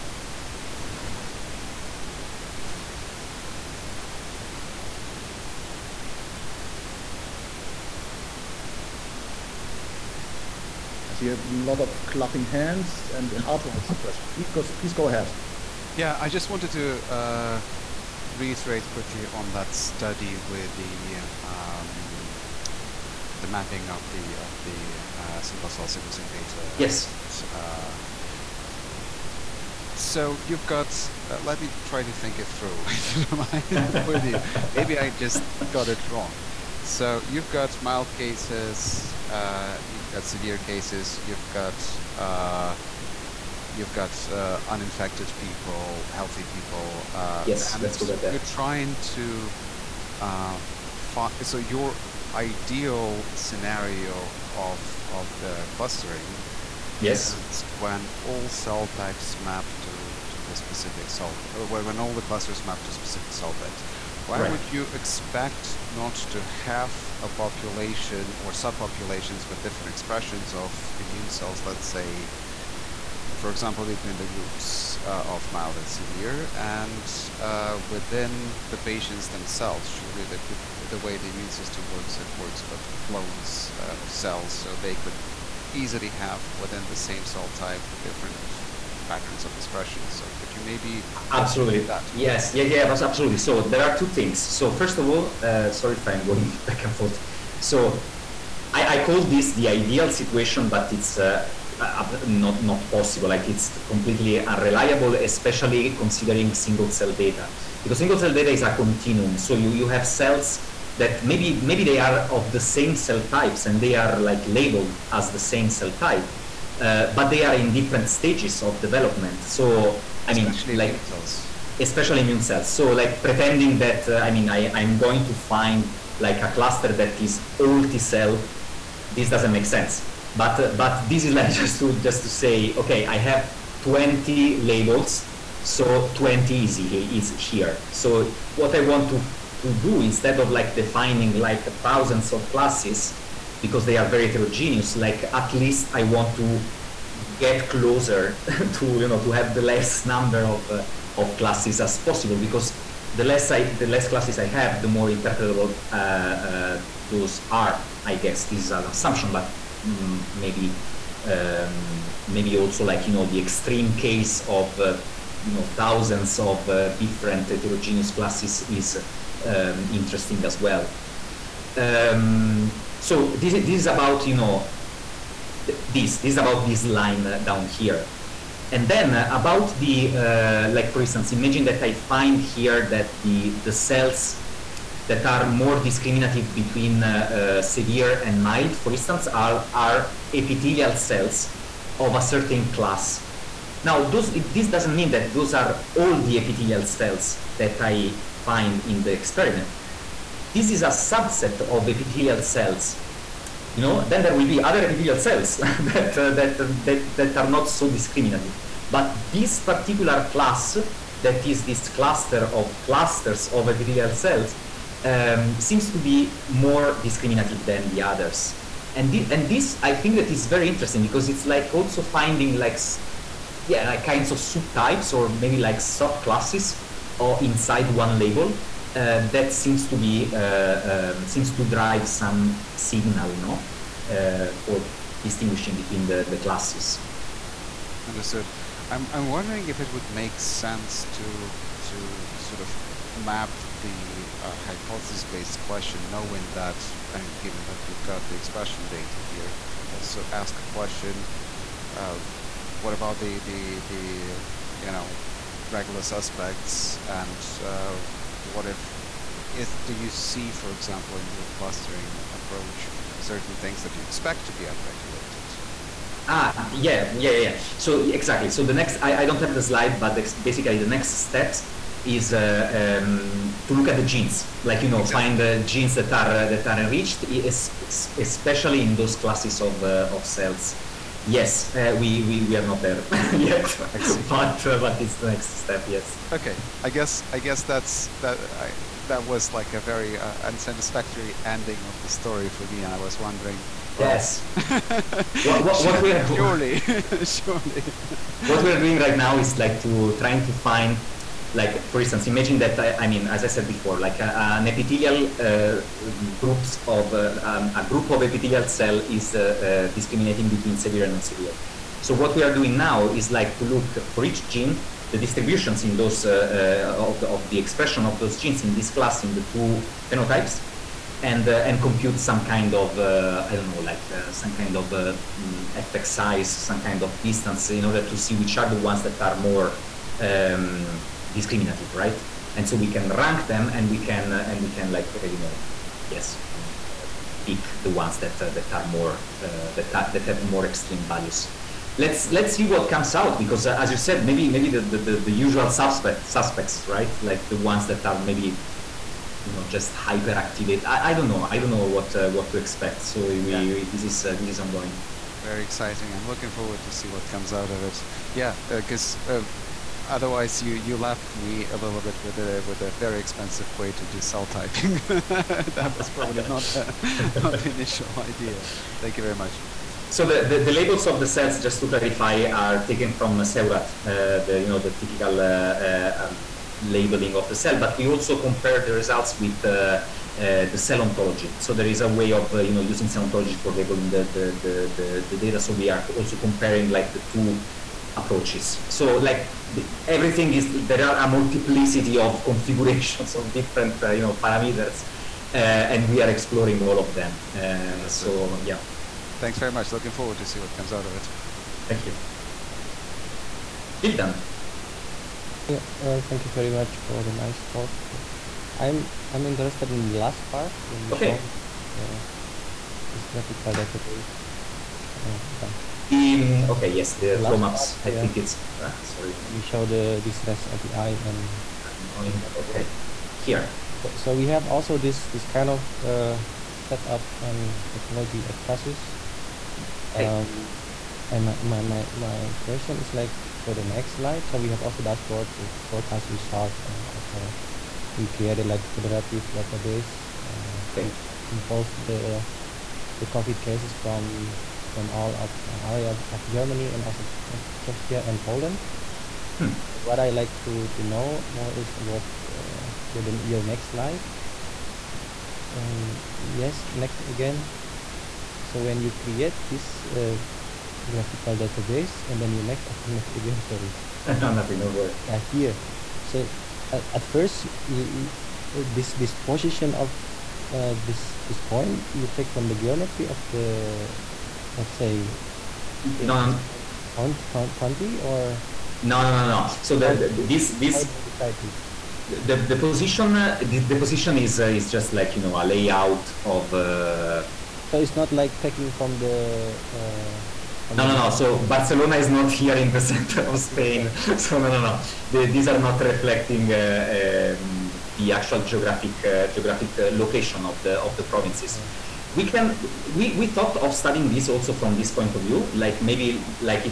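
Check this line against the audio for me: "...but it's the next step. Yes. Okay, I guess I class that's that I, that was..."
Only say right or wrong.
wrong.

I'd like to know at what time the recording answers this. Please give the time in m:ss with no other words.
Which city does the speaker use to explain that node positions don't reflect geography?
8:11.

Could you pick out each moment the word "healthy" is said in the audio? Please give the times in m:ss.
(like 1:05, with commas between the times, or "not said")
0:46.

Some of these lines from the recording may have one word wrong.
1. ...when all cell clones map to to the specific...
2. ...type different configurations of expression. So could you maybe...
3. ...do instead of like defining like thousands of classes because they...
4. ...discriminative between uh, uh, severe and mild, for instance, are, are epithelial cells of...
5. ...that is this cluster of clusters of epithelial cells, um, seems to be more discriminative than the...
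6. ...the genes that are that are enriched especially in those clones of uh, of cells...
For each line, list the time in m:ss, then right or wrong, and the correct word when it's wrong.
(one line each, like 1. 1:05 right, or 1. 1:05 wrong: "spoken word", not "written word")
1. 0:57 wrong: "types", not "clones"
2. 1:27 wrong: "patterns", not "configurations"
3. 2:19 right
4. 3:05 right
5. 3:31 right
6. 4:35 wrong: "classes", not "clones".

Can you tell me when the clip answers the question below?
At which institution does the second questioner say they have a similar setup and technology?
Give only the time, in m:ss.
7:08.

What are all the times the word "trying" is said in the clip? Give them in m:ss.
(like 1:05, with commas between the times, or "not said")
0:48, 5:00.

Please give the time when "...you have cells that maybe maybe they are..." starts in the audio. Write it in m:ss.
1:49.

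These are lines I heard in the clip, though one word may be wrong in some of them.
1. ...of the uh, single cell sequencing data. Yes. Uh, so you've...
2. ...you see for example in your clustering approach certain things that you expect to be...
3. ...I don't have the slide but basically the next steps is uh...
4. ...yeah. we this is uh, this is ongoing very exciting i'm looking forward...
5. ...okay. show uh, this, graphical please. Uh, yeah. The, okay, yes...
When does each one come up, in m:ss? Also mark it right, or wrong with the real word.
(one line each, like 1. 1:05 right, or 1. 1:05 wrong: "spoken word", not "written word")
1. 0:24 right
2. 4:19 right
3. 4:29 right
4. 5:53 right
5. 6:51 wrong: "database", not "please".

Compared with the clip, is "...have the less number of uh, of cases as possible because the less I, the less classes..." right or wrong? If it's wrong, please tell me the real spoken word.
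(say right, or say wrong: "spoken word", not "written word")
wrong: "classes", not "cases".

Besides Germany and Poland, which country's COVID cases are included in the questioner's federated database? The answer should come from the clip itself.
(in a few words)
Czechia.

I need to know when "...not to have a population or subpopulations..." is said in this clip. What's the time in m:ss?
1:05.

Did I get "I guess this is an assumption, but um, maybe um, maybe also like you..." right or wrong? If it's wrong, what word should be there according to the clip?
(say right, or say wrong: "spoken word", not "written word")
right.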